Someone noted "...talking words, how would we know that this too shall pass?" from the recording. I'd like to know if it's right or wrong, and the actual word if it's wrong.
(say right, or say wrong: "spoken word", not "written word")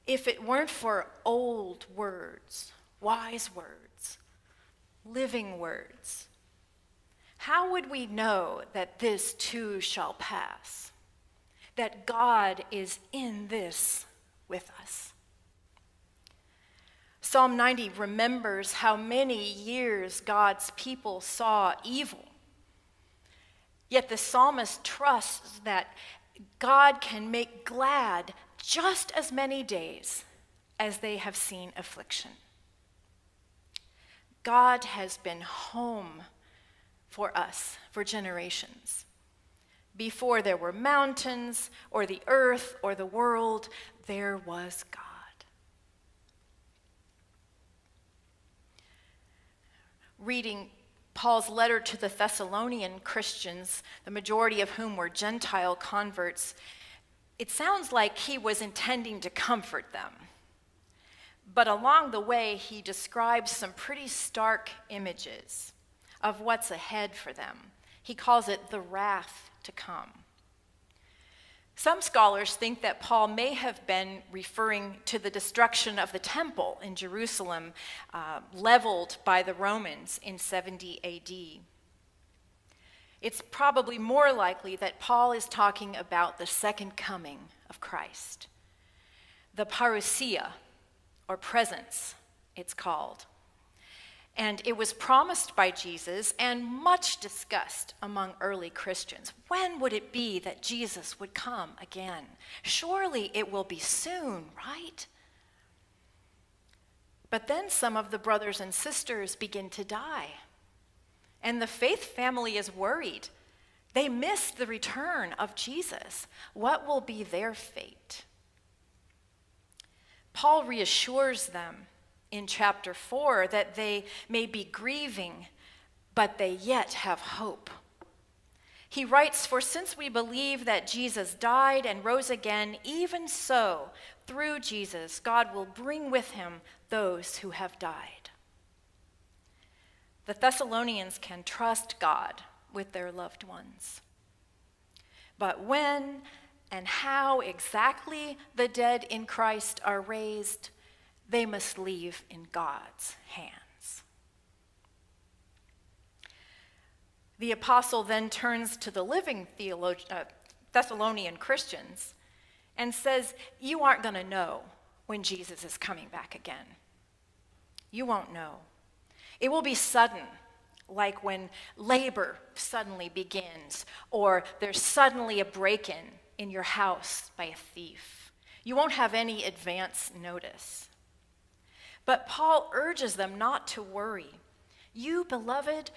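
wrong: "living", not "talking".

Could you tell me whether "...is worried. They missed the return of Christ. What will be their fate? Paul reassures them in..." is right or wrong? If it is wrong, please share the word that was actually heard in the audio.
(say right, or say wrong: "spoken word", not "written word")
wrong: "Jesus", not "Christ".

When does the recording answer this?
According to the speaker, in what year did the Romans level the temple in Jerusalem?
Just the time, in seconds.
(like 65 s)
80 s.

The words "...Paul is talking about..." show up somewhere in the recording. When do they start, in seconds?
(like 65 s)
85 s.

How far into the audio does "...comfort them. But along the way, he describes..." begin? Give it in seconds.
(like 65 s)
59 s.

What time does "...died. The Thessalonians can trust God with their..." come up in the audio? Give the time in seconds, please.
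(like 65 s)
137 s.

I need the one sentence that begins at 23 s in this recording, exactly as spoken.
Yet the psalmist trusts that God can make glad just as many days as they have seen affliction.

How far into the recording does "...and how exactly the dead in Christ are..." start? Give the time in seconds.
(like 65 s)
146 s.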